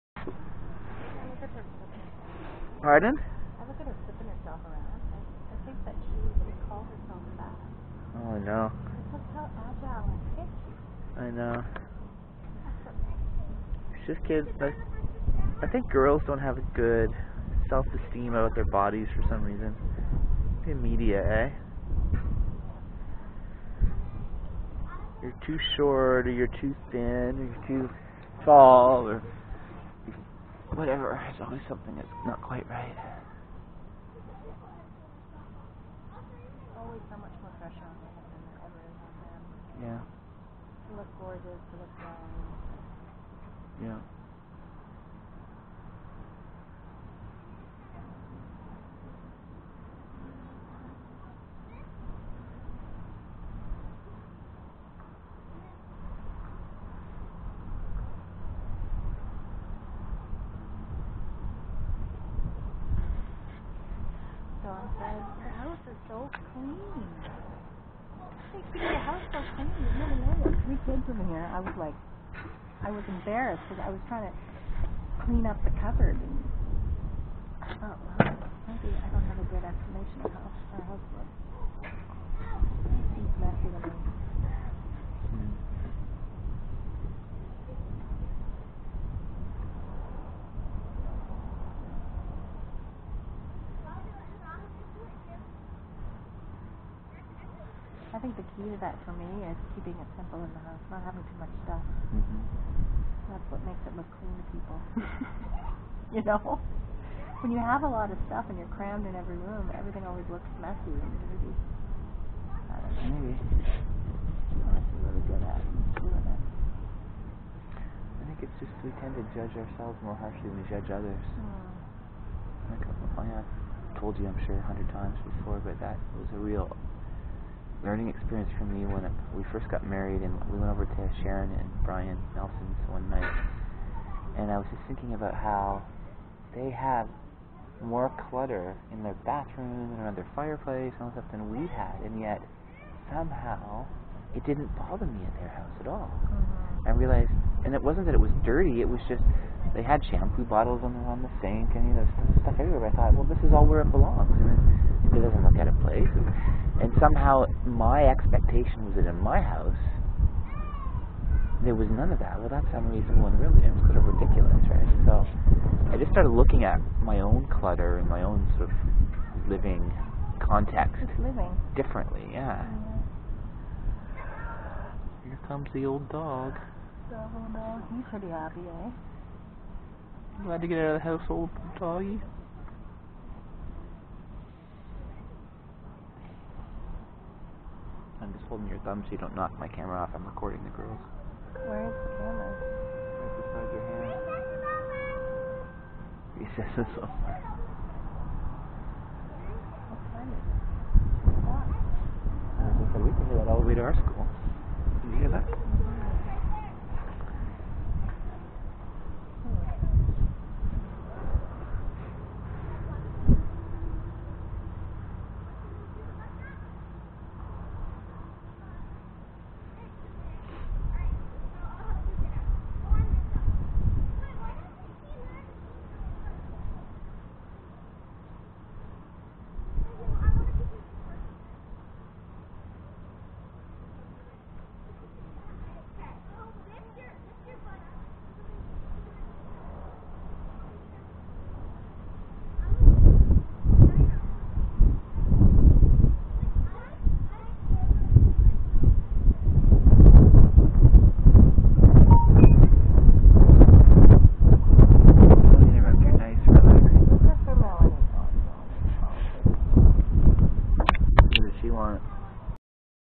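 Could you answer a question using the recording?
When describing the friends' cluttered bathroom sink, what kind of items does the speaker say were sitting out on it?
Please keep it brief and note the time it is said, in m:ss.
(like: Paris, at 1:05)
Shampoo bottles, at 2:30.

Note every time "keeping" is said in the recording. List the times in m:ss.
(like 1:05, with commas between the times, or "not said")
1:39.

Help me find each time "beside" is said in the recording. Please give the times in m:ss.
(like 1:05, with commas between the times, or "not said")
3:13.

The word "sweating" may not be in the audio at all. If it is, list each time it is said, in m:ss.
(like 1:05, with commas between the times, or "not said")
not said.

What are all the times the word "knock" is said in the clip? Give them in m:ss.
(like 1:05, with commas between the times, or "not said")
3:09.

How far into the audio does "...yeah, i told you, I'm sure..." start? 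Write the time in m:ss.
2:03.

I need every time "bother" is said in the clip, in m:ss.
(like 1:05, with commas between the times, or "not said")
2:24.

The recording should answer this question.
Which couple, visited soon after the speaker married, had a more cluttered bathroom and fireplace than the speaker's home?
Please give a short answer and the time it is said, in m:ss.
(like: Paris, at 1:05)
Sharon and Brian Nelson, at 2:11.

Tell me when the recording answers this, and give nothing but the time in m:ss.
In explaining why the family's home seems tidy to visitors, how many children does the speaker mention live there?
1:10.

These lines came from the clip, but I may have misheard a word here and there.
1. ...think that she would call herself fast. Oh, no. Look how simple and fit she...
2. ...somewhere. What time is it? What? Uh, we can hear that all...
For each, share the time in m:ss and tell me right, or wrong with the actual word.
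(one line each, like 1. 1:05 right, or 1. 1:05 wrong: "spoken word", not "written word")
1. 0:05 wrong: "agile", not "simple"
2. 3:16 right.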